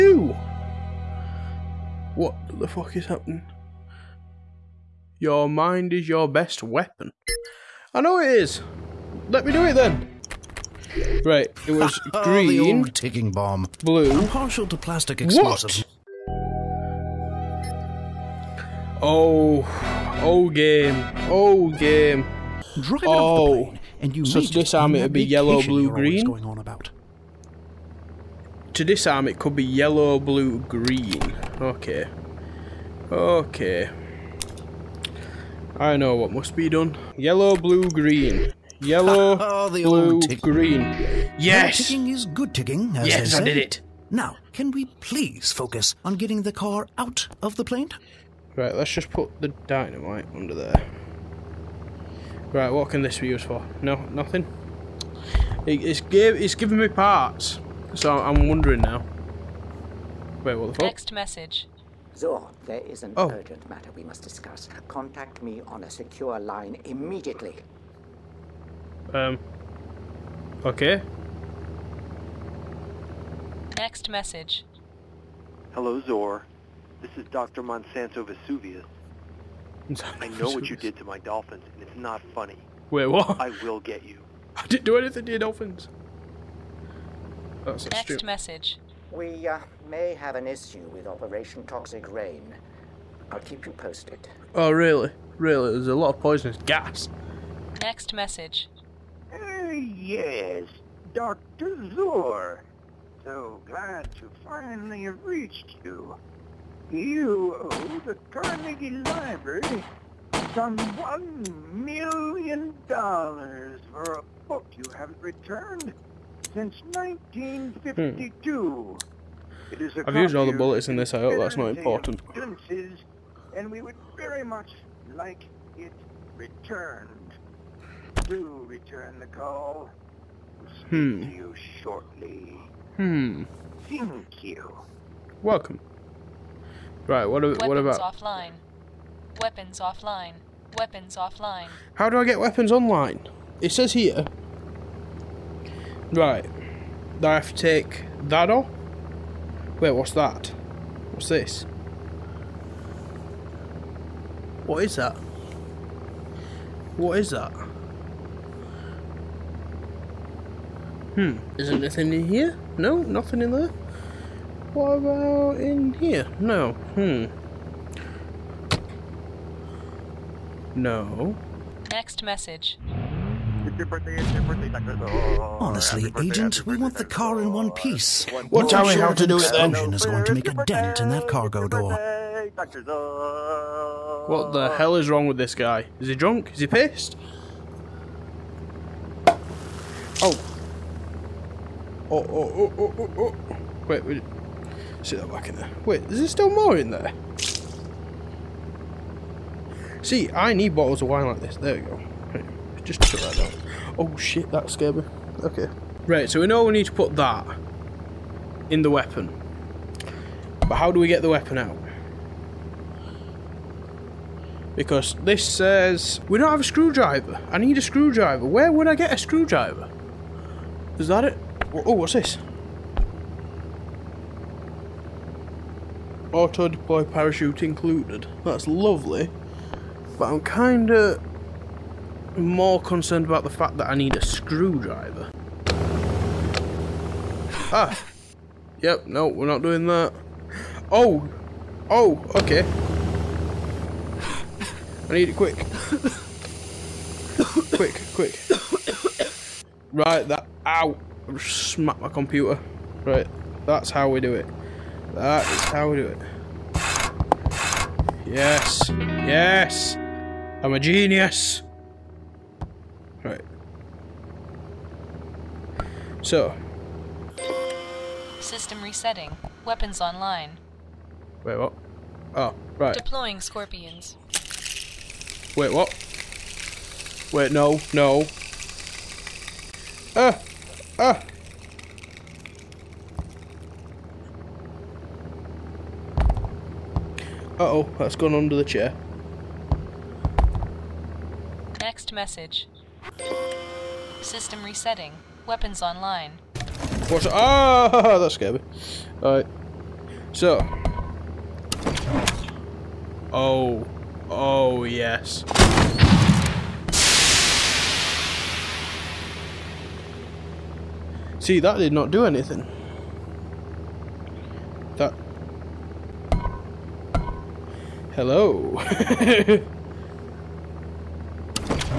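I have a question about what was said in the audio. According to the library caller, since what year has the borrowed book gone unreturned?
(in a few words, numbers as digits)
1952.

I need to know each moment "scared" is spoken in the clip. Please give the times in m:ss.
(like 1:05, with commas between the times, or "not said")
3:24, 4:58.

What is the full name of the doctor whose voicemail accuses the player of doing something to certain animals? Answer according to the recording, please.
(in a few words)
Monsanto Vesuvius.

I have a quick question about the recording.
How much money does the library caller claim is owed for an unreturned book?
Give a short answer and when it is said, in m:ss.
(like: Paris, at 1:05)
$1,000,000, at 1:50.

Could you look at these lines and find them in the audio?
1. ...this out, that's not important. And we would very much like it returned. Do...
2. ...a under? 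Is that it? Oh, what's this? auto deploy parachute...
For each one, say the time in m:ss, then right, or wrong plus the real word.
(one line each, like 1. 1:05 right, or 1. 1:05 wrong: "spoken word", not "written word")
1. 2:00 right
2. 3:39 wrong: "screwdriver", not "under".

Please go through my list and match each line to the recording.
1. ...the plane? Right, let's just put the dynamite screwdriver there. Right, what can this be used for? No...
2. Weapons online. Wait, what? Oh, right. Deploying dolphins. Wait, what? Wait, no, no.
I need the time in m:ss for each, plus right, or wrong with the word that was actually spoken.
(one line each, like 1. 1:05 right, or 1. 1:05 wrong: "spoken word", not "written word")
1. 0:47 wrong: "under", not "screwdriver"
2. 4:29 wrong: "scorpions", not "dolphins".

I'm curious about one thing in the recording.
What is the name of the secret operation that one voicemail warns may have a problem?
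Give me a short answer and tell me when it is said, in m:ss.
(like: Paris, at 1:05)
Operation Toxic Rain, at 1:31.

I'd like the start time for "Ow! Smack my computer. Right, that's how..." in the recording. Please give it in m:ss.
4:10.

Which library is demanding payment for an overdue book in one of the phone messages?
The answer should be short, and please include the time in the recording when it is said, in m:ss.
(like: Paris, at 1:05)
Carnegie Library, at 1:48.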